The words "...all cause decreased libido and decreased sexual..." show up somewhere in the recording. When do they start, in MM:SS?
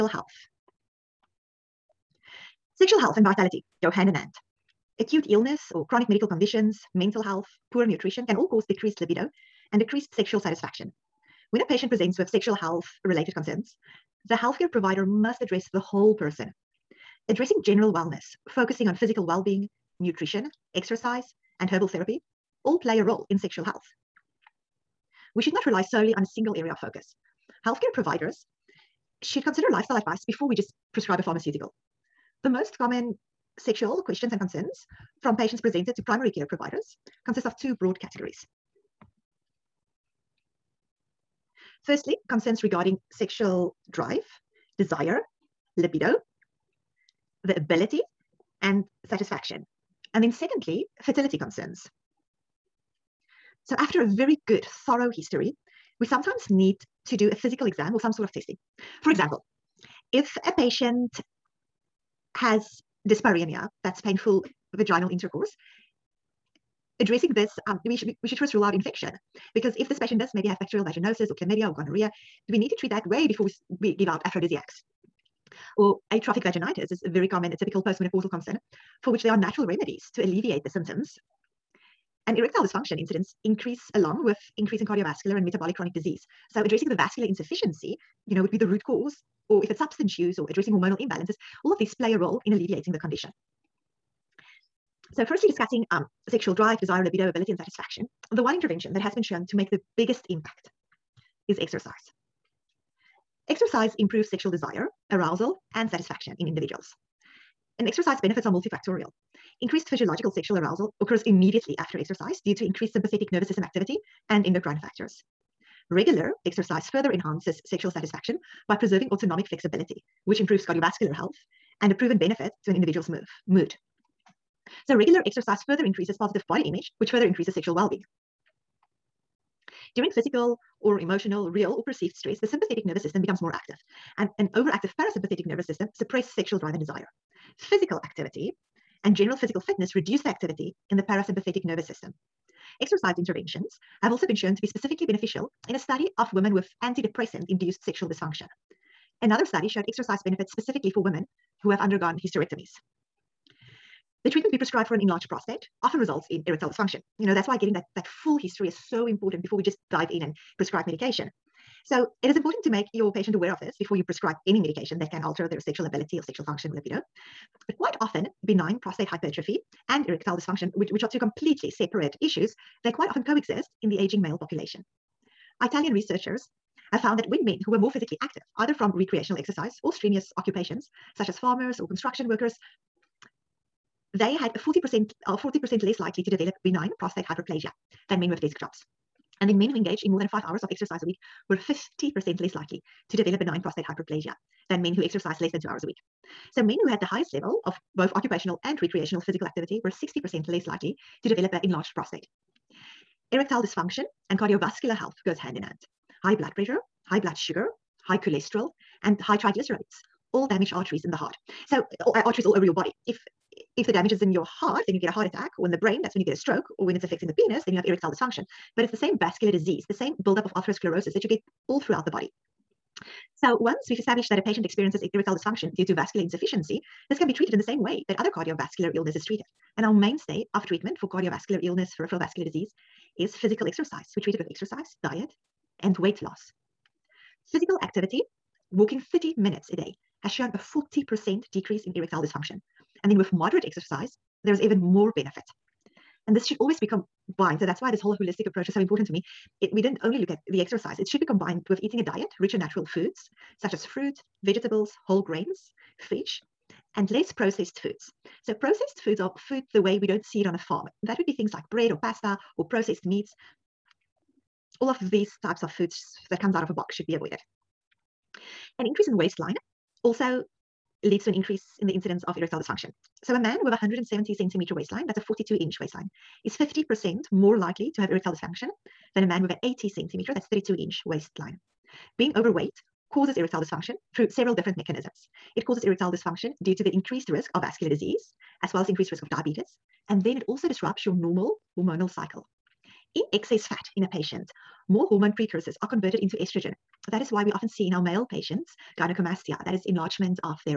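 00:08.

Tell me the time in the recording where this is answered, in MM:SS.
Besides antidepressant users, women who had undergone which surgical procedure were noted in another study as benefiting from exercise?
02:32.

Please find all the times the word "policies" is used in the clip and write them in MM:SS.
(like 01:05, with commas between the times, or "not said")
not said.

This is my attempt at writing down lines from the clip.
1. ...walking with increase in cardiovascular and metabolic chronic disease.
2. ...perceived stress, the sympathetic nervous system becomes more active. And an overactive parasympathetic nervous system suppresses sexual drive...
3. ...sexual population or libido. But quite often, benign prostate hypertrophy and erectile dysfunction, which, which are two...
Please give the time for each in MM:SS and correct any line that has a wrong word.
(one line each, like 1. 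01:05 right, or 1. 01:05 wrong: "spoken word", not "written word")
1. 01:23 wrong: "along", not "walking"
2. 02:11 right
3. 02:46 wrong: "function", not "population".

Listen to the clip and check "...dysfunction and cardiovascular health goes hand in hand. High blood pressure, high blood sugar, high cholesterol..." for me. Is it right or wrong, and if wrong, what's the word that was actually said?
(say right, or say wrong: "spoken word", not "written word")
right.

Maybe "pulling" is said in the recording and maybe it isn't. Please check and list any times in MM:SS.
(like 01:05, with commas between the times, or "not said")
not said.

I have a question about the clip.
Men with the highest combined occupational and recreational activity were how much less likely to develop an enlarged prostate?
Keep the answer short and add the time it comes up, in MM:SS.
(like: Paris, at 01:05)
60%, at 03:19.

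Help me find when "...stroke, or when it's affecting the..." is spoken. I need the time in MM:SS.
03:36.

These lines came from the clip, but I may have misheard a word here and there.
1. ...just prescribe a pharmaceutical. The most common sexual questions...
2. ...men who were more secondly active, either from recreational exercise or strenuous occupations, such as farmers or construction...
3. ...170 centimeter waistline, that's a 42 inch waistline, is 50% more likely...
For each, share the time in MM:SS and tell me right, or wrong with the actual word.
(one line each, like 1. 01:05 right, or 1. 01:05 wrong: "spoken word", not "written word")
1. 00:30 right
2. 02:57 wrong: "physically", not "secondly"
3. 04:33 right.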